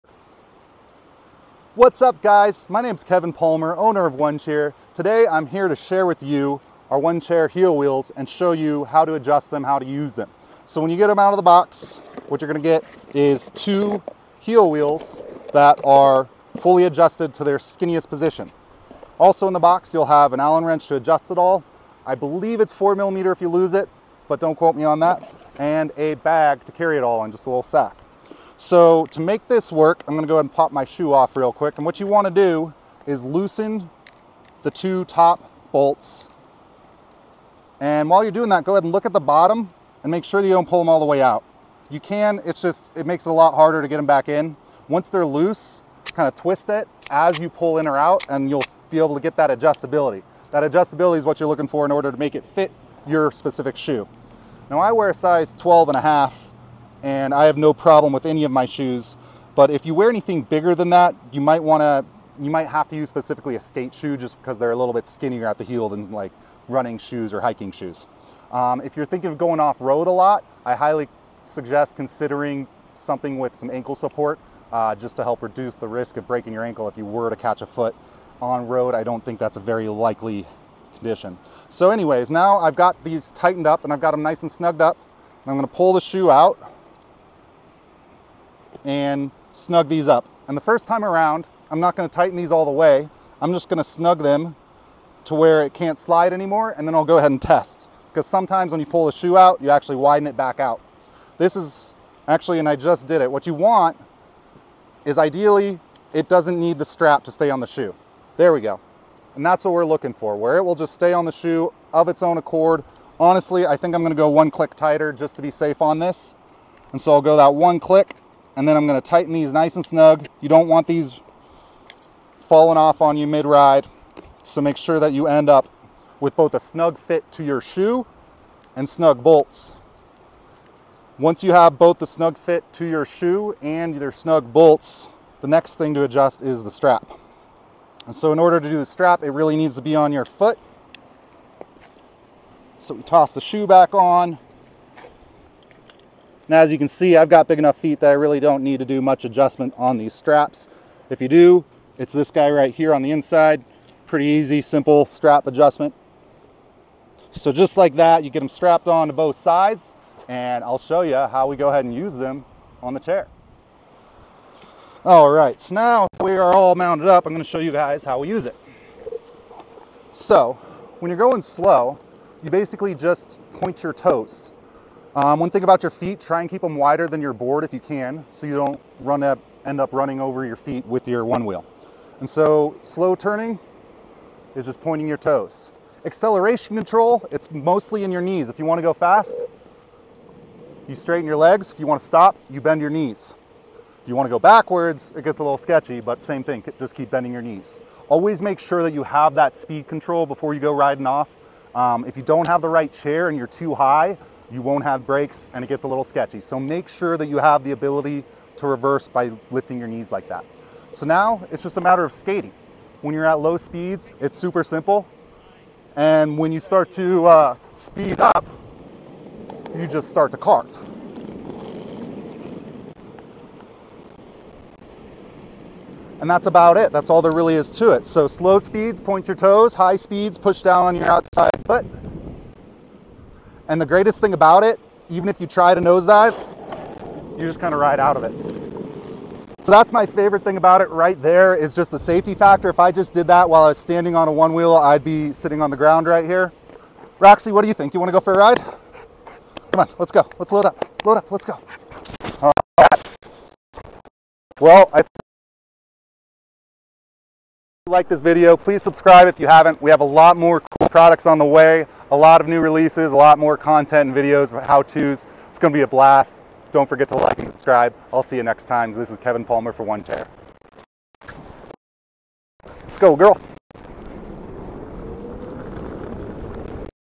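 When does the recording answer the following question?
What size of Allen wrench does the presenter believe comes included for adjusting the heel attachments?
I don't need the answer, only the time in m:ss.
0:22.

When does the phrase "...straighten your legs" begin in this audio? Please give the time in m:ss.
3:10.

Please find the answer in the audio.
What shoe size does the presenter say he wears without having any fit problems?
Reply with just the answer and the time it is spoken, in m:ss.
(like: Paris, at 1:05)
12 and a half, at 0:55.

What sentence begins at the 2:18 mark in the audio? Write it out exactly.
And so in order to do the strap, it really needs to be on your foot.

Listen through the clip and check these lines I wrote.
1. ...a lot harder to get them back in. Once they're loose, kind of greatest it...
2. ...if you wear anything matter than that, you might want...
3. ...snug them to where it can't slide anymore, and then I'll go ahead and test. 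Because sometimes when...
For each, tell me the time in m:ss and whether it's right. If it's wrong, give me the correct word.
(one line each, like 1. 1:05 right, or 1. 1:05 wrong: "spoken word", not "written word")
1. 0:43 wrong: "twist", not "greatest"
2. 0:59 wrong: "bigger", not "matter"
3. 1:33 right.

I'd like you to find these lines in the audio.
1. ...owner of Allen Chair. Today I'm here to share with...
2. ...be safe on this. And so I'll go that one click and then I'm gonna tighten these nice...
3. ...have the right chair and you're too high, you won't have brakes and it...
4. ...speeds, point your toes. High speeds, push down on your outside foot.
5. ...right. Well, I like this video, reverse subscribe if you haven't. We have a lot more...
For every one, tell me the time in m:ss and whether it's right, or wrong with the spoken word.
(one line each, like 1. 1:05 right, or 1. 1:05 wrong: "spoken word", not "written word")
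1. 0:03 wrong: "One", not "Allen"
2. 1:55 right
3. 3:22 right
4. 3:48 right
5. 4:12 wrong: "please", not "reverse".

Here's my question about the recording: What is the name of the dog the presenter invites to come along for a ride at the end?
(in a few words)
Roxy.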